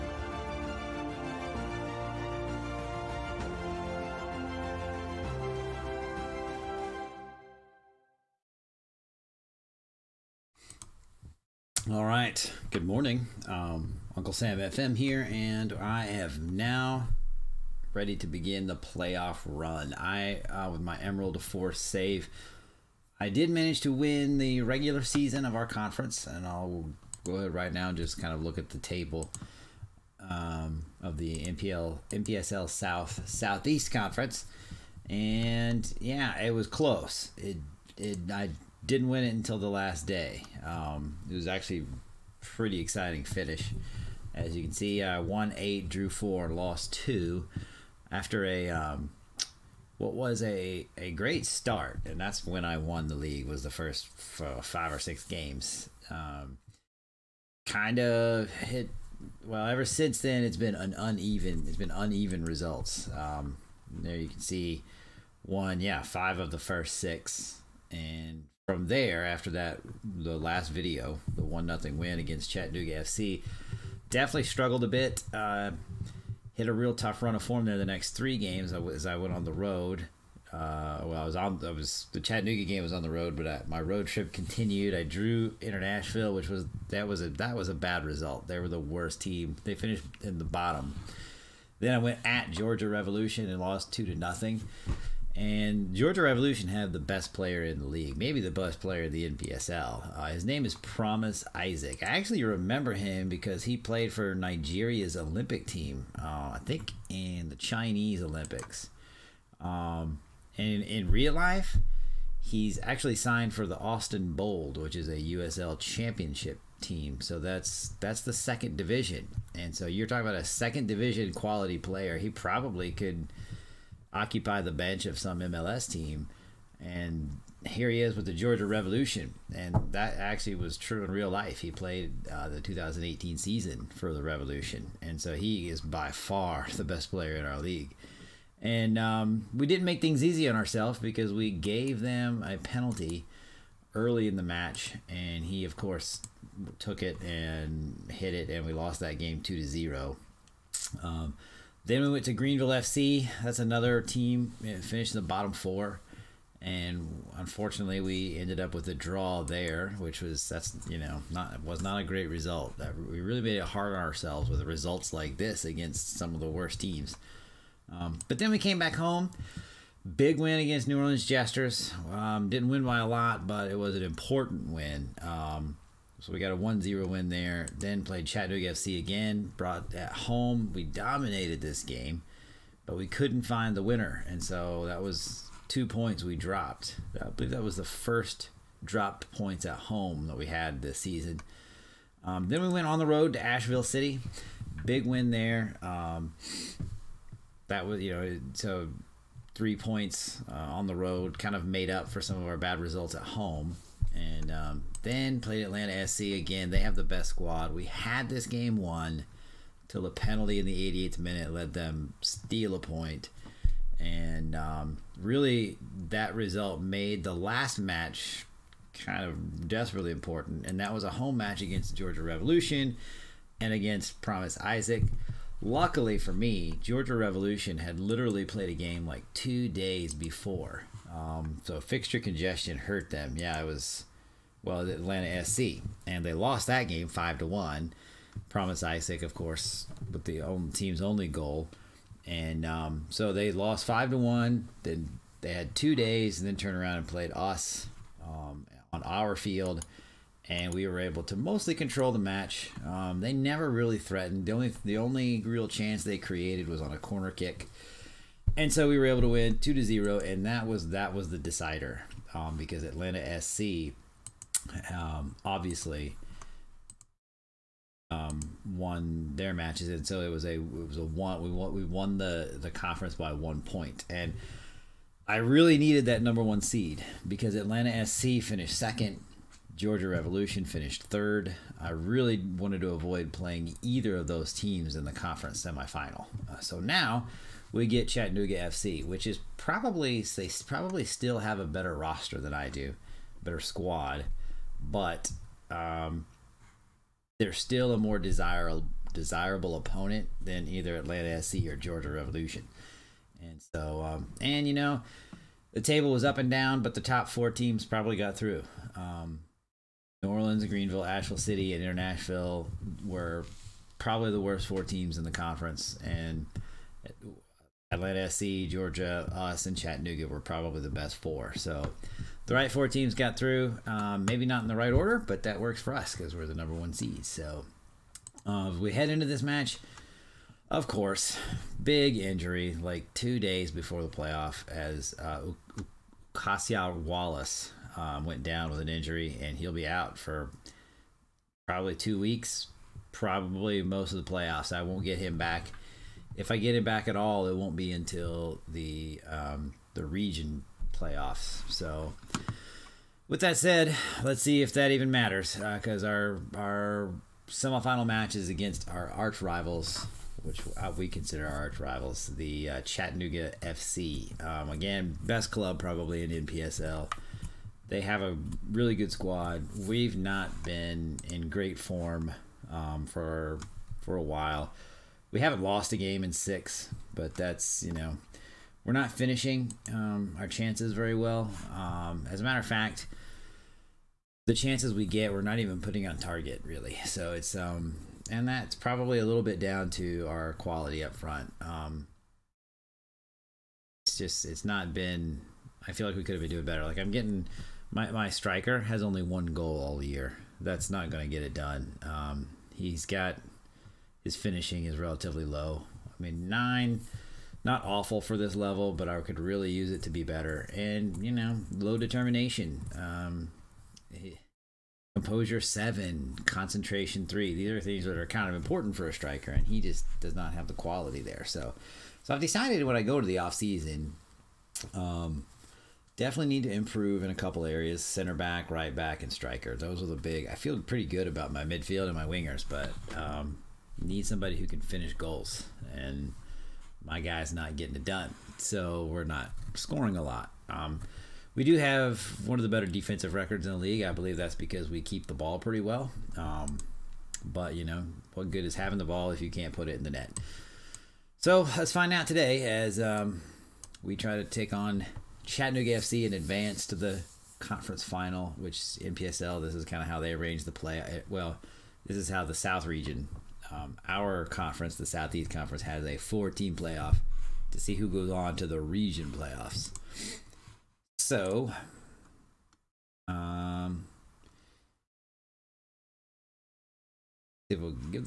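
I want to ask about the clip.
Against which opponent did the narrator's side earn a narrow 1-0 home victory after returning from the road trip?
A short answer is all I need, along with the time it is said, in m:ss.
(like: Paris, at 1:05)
New Orleans Jesters, at 2:50.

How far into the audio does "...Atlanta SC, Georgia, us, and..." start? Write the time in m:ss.
5:17.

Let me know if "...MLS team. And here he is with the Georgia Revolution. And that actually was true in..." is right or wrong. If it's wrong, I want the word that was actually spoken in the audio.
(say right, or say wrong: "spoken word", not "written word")
right.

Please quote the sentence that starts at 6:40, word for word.
That's not going to get it done.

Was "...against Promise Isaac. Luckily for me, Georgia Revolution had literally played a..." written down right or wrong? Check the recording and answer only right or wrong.
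right.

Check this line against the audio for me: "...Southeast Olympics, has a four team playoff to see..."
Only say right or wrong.
wrong.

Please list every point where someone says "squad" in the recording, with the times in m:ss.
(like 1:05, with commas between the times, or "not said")
3:27, 4:53, 6:09.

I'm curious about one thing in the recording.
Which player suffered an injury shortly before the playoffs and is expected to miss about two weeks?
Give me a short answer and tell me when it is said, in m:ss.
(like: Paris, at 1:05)
Kasia Wallace, at 5:36.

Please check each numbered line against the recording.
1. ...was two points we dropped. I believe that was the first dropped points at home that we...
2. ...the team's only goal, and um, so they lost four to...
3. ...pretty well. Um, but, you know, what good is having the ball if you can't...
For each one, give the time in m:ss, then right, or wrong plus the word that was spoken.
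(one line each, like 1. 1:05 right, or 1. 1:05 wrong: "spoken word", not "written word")
1. 3:05 right
2. 4:00 wrong: "five", not "four"
3. 7:25 right.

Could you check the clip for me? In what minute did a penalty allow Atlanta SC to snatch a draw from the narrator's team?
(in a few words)
88th minute.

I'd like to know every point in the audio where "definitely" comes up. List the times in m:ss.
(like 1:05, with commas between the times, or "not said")
1:14, 7:06.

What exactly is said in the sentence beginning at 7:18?
So we're not scoring a lot.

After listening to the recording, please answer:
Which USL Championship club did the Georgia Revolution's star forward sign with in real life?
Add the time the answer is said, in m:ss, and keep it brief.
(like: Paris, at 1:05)
Austin Bold, at 1:53.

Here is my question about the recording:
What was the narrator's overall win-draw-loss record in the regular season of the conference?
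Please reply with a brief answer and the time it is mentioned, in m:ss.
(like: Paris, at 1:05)
8 wins, 4 draws, 2 losses, at 0:45.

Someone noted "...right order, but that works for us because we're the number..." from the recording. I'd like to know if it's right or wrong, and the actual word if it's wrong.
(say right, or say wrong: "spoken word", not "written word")
right.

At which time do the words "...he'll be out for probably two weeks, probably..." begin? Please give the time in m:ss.
5:39.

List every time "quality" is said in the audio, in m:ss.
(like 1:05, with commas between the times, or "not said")
2:01, 6:30, 7:00.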